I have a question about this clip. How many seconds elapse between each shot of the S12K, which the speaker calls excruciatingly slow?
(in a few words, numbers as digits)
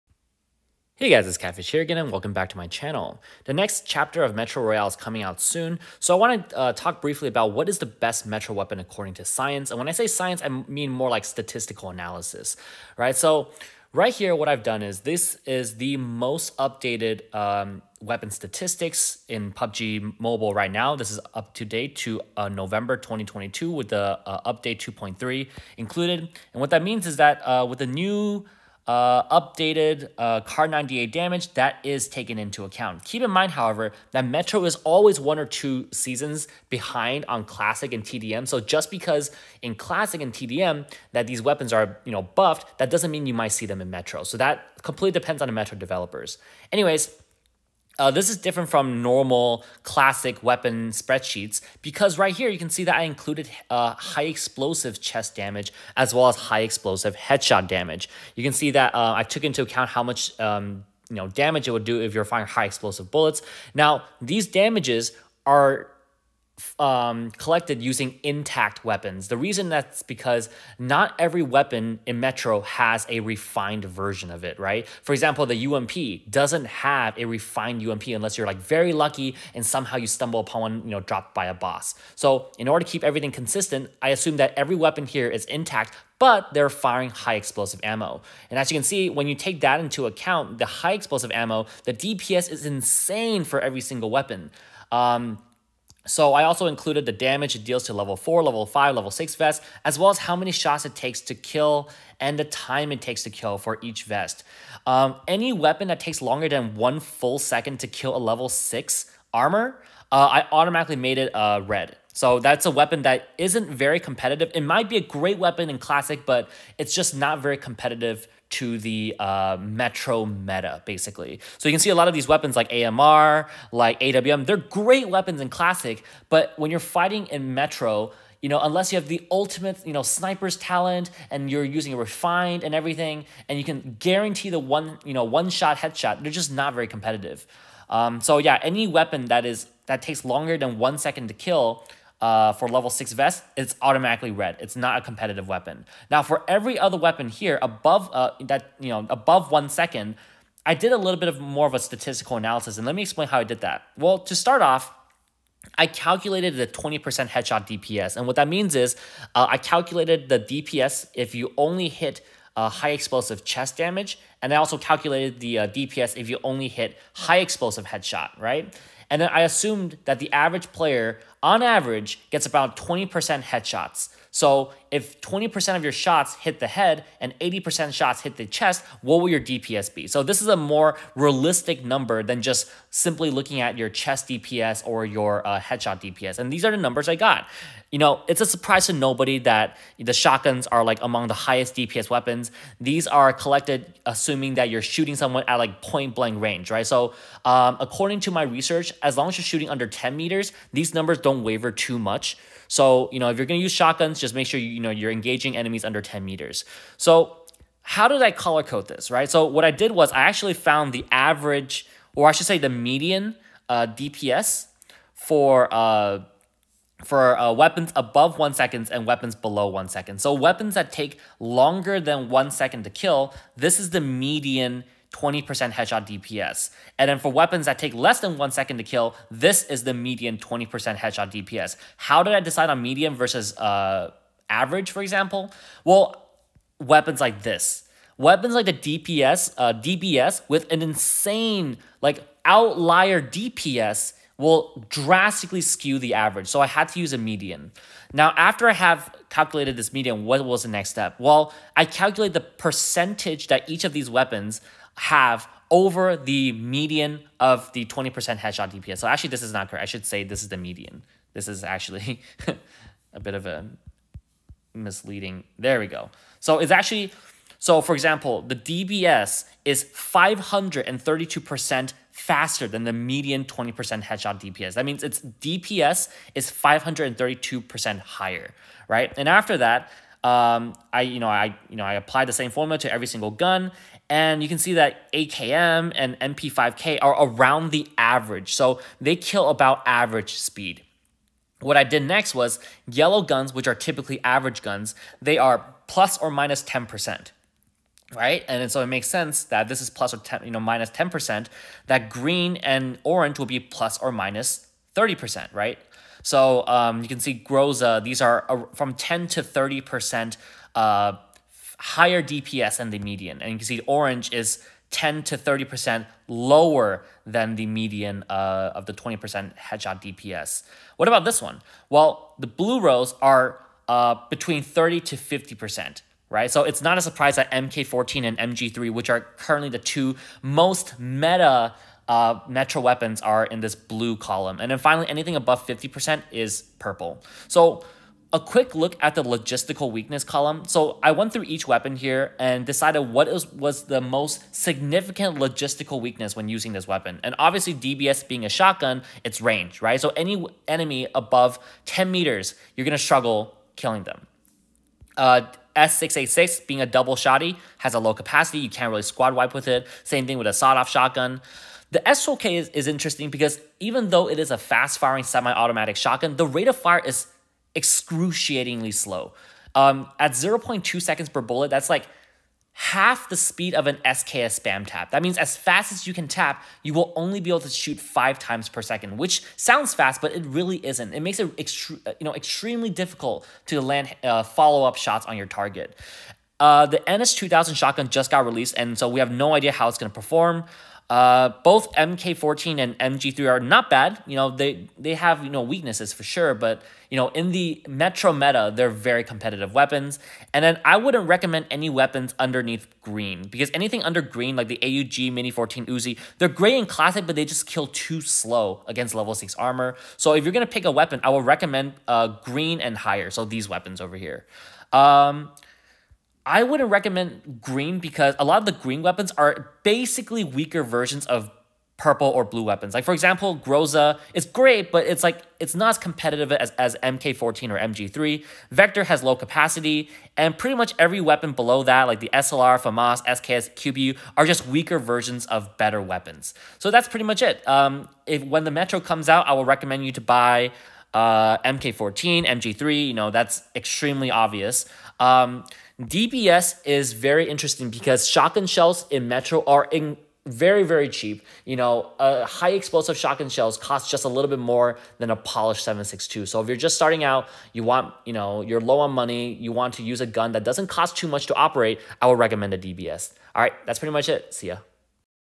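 0.2 seconds.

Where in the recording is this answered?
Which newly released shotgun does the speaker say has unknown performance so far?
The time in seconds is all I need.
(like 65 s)
386 s.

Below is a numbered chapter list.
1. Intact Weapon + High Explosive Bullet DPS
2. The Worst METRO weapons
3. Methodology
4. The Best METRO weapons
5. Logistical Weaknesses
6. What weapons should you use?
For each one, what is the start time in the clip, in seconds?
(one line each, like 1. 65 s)
1. 47 s
2. 104 s
3. 154 s
4. 322 s
5. 338 s
6. 401 s.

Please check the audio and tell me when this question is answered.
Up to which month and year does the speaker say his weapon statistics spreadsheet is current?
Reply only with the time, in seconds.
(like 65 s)
22 s.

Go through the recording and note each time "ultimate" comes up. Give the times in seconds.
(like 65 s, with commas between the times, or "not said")
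129 s.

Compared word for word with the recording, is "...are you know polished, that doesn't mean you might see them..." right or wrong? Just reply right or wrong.
wrong.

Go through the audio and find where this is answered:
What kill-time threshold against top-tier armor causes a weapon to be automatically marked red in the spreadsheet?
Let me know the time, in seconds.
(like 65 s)
106 s.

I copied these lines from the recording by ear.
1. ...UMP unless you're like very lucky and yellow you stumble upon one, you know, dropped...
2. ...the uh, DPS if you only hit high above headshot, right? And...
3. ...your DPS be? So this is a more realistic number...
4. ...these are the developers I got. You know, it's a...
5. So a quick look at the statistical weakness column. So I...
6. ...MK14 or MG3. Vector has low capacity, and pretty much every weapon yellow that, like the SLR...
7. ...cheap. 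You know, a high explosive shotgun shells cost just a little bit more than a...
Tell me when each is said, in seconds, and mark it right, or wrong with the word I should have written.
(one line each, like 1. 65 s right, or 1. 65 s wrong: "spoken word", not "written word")
1. 77 s wrong: "somehow", not "yellow"
2. 165 s wrong: "explosive", not "above"
3. 179 s right
4. 186 s wrong: "numbers", not "developers"
5. 337 s wrong: "logistical", not "statistical"
6. 427 s wrong: "below", not "yellow"
7. 451 s right.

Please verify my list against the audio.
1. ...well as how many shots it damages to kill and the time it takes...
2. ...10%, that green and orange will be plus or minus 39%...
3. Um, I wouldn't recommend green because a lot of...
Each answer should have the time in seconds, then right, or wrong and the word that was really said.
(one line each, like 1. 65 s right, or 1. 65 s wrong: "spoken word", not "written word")
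1. 99 s wrong: "takes", not "damages"
2. 300 s wrong: "30", not "39"
3. 414 s right.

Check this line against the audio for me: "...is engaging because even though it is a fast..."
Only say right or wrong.
wrong.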